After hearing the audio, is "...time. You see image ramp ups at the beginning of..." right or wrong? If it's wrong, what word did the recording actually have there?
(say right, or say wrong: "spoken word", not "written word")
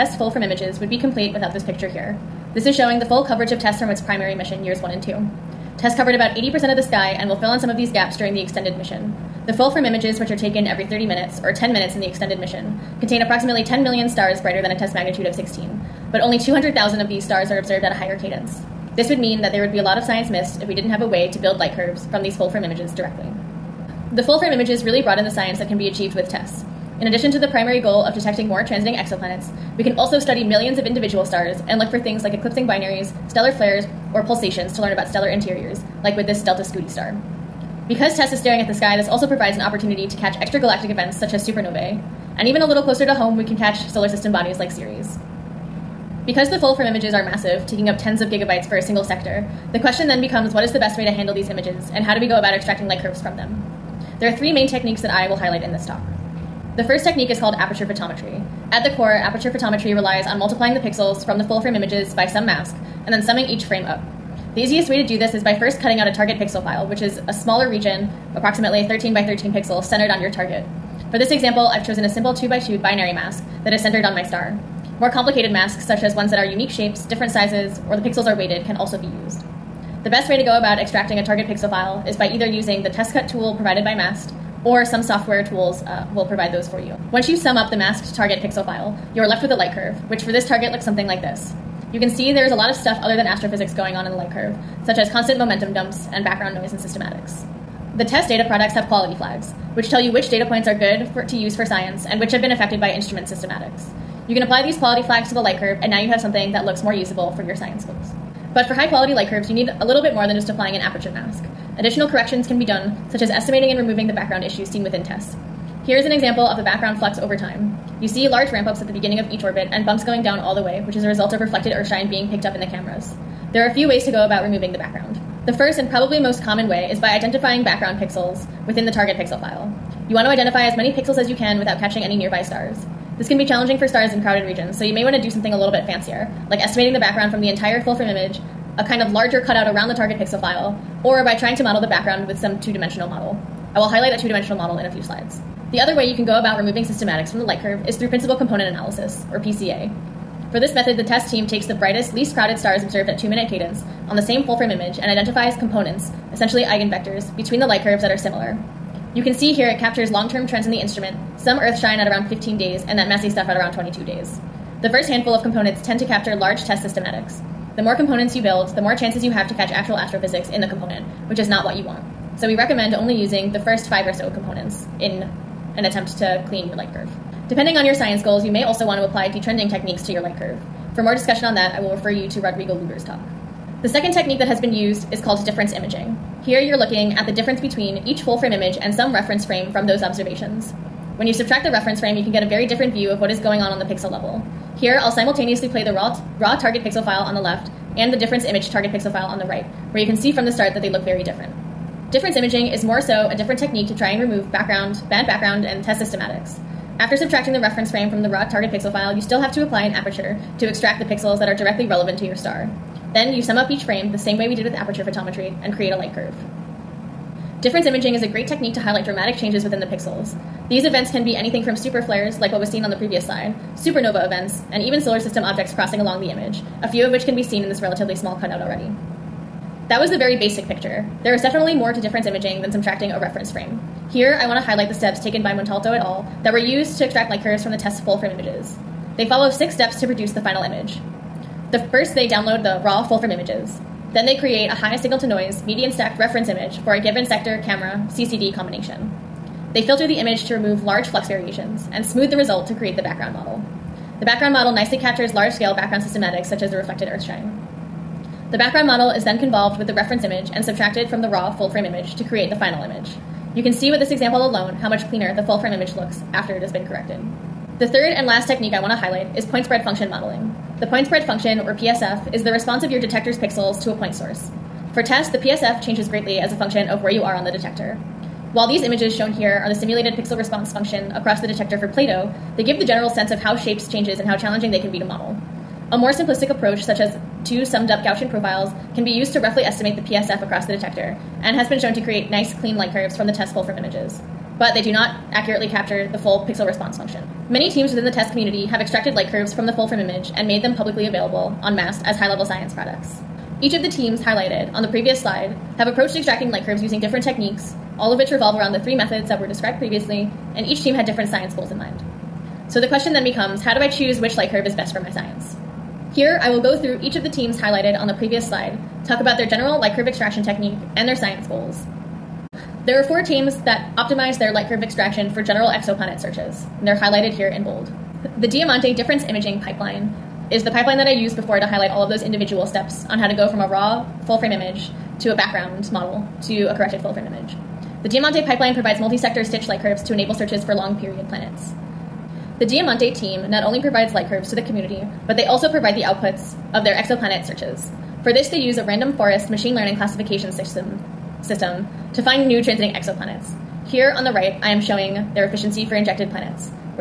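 wrong: "large", not "image".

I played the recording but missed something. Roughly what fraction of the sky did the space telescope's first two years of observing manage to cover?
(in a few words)
80%.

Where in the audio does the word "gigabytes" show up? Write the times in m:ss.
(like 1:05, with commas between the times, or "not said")
0:48.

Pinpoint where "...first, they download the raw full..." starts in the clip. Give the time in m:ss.
4:01.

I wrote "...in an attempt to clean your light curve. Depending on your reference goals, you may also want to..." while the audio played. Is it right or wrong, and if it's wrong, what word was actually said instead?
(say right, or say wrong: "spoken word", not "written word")
wrong: "science", not "reference".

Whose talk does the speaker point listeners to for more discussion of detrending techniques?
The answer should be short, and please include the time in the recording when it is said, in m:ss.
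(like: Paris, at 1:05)
Rodrigo Luger, at 3:02.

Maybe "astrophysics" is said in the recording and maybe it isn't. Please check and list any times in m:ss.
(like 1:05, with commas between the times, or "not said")
1:33, 2:49.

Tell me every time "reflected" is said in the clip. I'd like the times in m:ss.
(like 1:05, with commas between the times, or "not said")
2:01, 4:16.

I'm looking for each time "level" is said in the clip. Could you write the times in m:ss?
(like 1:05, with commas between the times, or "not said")
3:14, 5:02.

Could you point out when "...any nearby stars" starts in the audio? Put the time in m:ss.
2:12.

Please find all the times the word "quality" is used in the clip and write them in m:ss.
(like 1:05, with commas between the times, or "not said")
1:38, 1:44, 1:48.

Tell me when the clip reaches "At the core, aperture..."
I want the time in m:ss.
0:58.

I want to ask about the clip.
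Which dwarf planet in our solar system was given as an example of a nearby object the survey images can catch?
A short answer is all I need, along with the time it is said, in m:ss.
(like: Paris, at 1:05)
Ceres, at 0:44.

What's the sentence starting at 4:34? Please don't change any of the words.
For TESS, the PSF changes greatly as a function of where you are on the detector.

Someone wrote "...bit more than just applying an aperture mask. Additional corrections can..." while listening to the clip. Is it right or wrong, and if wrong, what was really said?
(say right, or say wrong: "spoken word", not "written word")
right.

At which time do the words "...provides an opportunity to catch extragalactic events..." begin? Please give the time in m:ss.
0:39.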